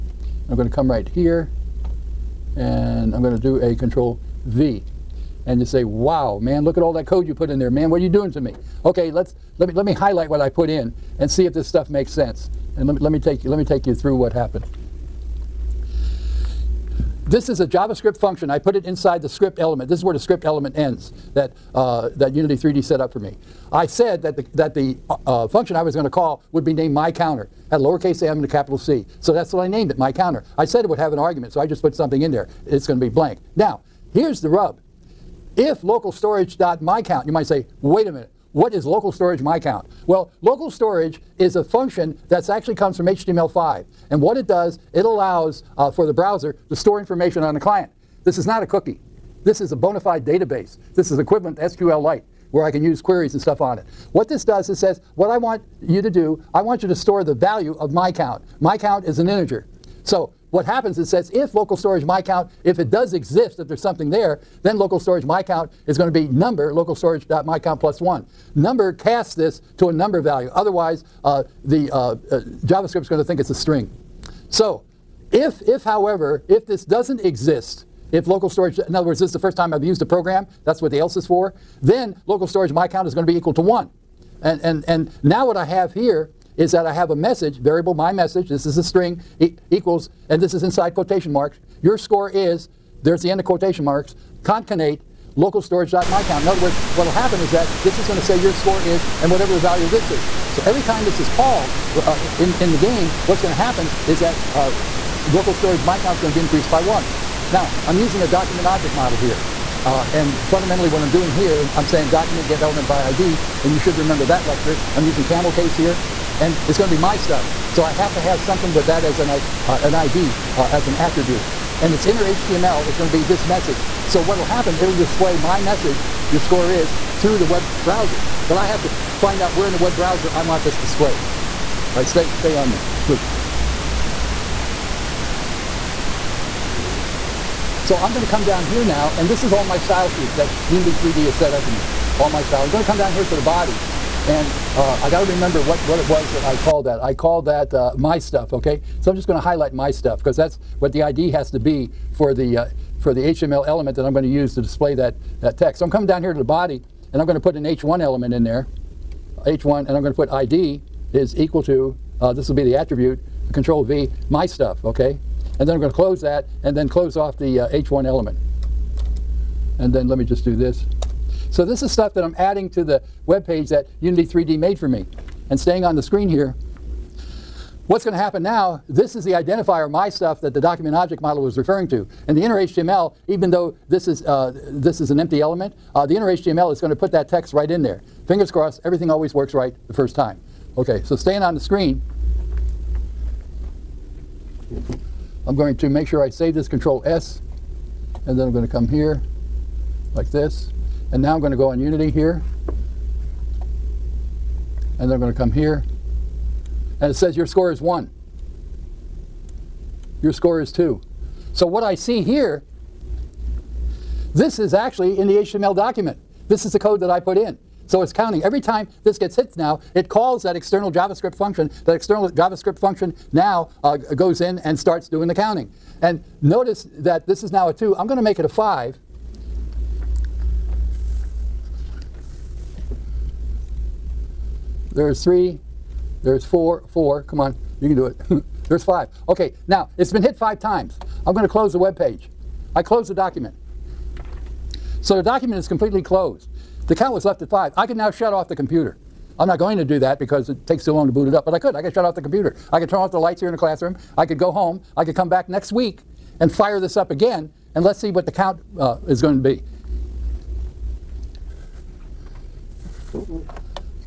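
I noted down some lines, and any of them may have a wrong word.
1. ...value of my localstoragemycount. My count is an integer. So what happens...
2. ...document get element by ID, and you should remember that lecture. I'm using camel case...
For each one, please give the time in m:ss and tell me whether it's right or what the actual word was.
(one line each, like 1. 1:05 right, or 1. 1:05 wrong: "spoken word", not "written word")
1. 0:57 wrong: "count", not "localstoragemycount"
2. 1:52 right.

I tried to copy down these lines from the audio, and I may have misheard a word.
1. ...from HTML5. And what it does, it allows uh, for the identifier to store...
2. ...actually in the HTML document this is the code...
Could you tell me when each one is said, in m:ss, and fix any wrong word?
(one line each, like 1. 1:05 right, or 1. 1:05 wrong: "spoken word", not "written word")
1. 0:42 wrong: "browser", not "identifier"
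2. 3:34 right.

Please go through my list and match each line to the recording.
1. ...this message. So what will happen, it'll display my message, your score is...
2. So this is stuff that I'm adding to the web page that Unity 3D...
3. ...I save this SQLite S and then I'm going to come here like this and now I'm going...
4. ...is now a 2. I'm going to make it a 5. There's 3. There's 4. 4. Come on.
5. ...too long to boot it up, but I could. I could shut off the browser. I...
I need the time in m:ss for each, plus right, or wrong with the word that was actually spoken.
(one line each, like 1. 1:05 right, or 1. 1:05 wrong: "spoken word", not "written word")
1. 2:03 right
2. 2:51 right
3. 3:16 wrong: "Control", not "SQLite"
4. 3:47 right
5. 4:10 wrong: "computer", not "browser".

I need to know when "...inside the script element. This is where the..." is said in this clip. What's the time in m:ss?
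0:18.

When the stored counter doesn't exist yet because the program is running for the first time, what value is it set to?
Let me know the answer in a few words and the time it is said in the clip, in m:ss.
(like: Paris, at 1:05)
1, at 1:23.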